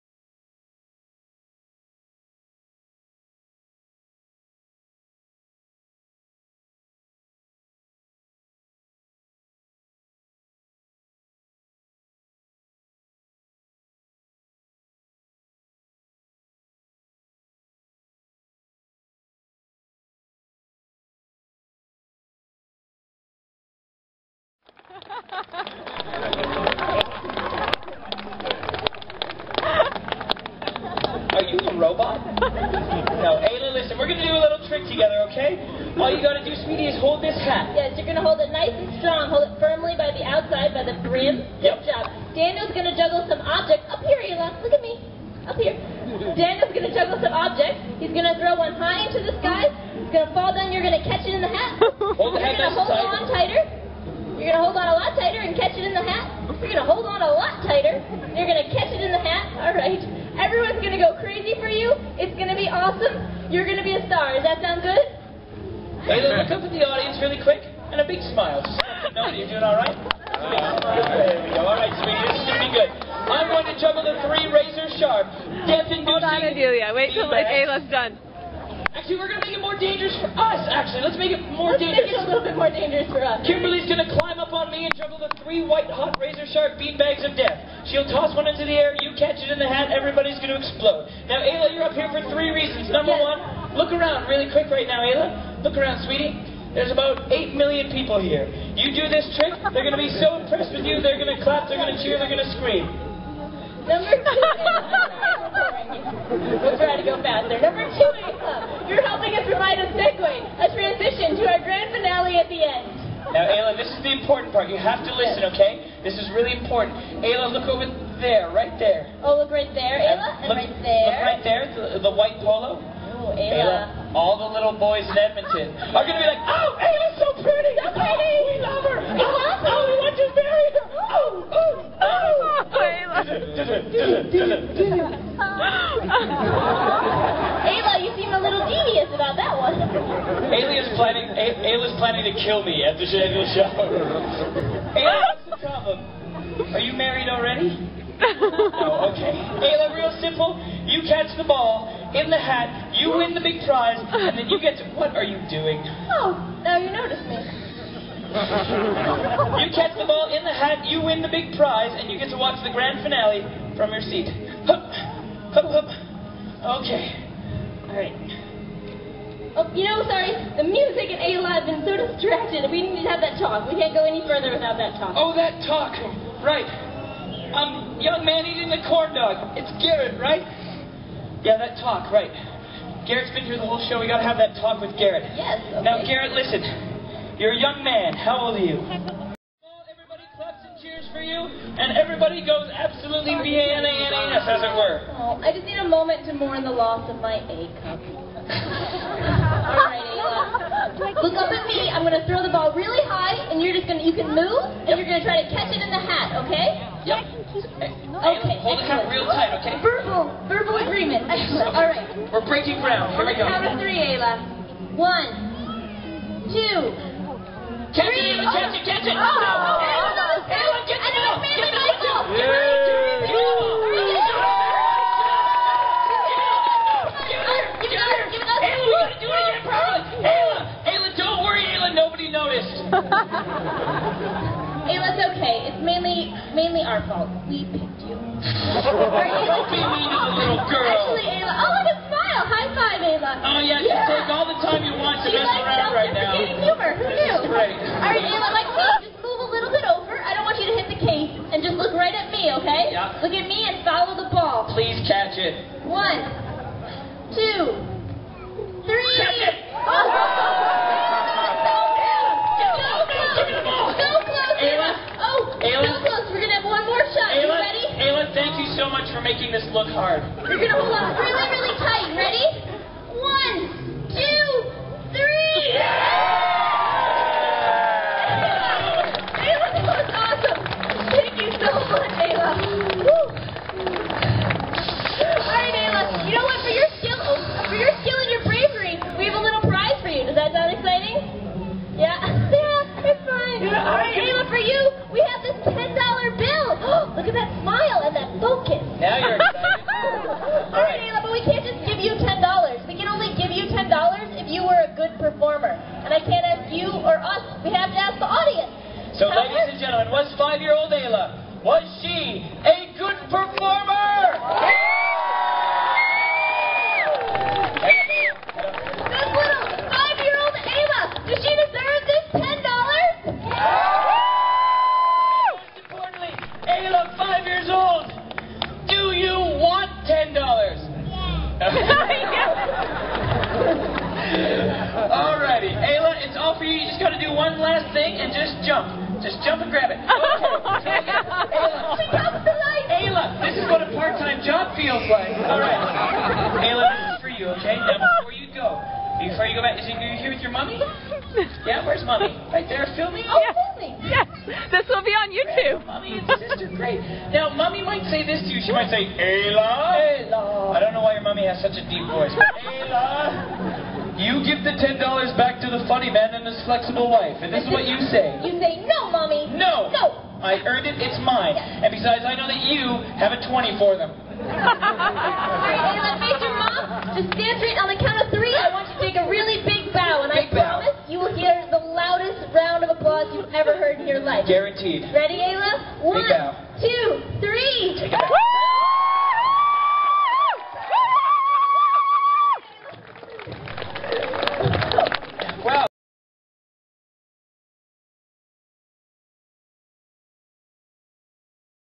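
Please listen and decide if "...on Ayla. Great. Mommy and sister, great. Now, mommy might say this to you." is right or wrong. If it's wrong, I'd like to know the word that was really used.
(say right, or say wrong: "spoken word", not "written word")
wrong: "YouTube", not "Ayla".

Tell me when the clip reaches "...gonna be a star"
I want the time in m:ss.
1:03.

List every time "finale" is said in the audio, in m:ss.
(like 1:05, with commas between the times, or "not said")
1:51, 2:43.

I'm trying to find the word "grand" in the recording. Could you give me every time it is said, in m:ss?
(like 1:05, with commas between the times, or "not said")
1:51, 2:42.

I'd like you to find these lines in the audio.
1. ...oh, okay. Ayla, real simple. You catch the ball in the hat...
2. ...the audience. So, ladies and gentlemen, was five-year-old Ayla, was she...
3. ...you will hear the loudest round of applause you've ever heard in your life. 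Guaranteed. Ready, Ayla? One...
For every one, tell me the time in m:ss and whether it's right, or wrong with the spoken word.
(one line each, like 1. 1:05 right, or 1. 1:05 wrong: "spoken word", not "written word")
1. 2:28 right
2. 5:08 right
3. 6:21 right.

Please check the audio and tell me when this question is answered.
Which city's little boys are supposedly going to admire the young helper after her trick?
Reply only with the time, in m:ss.
2:05.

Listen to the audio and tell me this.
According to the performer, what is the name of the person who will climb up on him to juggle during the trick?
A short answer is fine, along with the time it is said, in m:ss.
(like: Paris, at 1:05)
Kimberly, at 1:23.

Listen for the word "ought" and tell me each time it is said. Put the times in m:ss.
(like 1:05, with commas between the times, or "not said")
not said.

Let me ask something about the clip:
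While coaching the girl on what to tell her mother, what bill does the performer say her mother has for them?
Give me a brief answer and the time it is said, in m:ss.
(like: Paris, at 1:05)
20, at 6:13.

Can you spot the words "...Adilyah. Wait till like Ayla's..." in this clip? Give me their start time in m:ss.
1:16.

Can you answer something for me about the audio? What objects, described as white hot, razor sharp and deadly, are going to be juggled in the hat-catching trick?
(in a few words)
beanbags.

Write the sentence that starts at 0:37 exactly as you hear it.
Yes, you're gonna hold it nice and strong.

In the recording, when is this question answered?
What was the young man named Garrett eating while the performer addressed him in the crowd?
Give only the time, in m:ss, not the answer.
2:58.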